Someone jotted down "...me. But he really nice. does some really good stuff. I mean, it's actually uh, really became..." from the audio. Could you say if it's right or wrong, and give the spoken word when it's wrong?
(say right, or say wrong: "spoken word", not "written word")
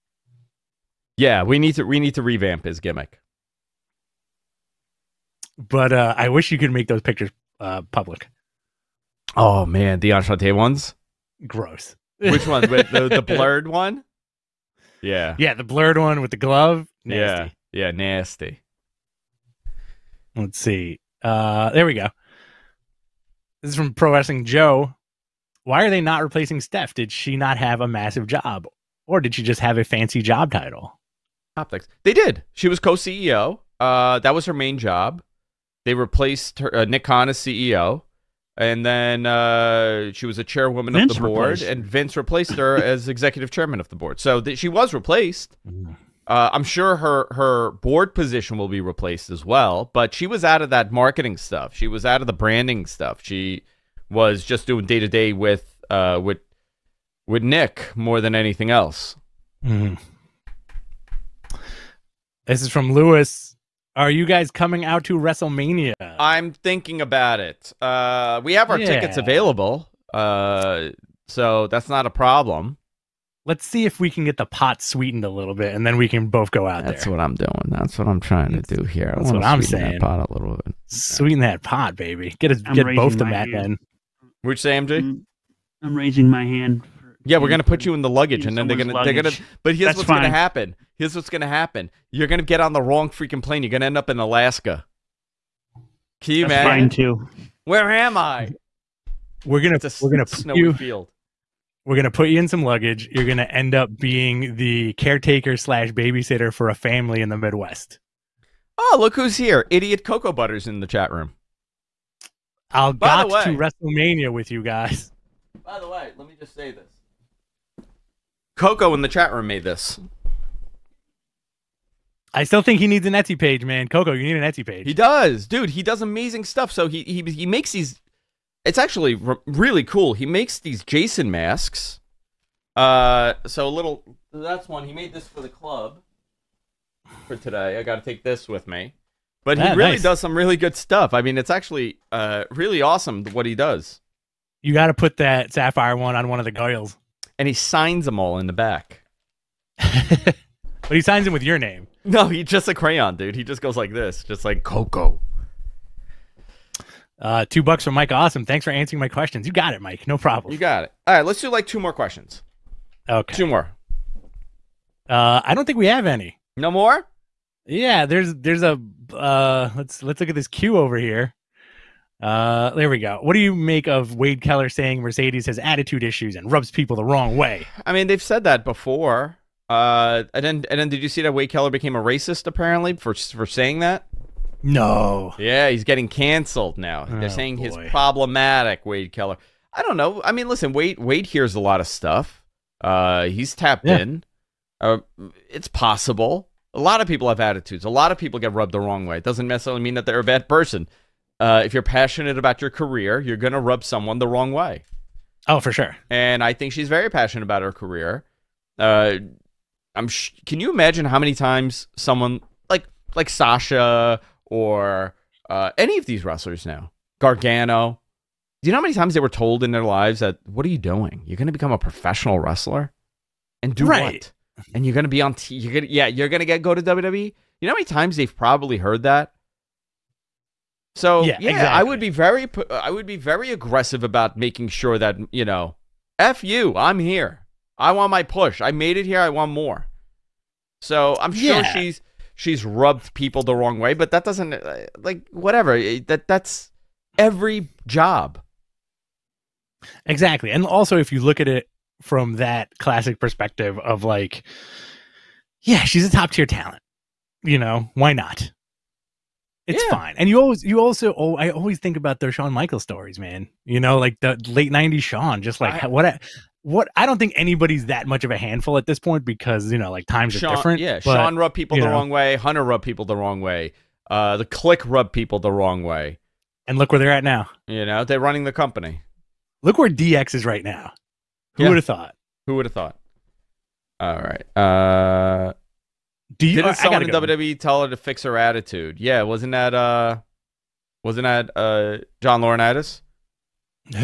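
wrong: "awesome", not "became".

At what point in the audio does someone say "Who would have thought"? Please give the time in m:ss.
4:42.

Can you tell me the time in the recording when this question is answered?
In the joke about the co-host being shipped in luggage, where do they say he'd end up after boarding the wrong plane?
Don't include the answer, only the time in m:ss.
1:34.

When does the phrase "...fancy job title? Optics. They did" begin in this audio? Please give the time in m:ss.
0:29.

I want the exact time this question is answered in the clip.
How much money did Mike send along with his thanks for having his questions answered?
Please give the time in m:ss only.
2:37.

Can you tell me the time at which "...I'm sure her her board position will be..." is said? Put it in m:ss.
0:46.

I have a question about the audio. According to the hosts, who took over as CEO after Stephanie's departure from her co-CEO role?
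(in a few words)
Nick Khan.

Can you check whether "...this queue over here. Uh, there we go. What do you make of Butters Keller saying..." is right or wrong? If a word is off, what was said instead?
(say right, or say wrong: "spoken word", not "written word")
wrong: "Wade", not "Butters".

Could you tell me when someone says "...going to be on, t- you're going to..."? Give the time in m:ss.
3:44.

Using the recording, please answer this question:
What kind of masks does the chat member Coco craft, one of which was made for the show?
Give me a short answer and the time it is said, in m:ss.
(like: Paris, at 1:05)
Jason masks, at 2:10.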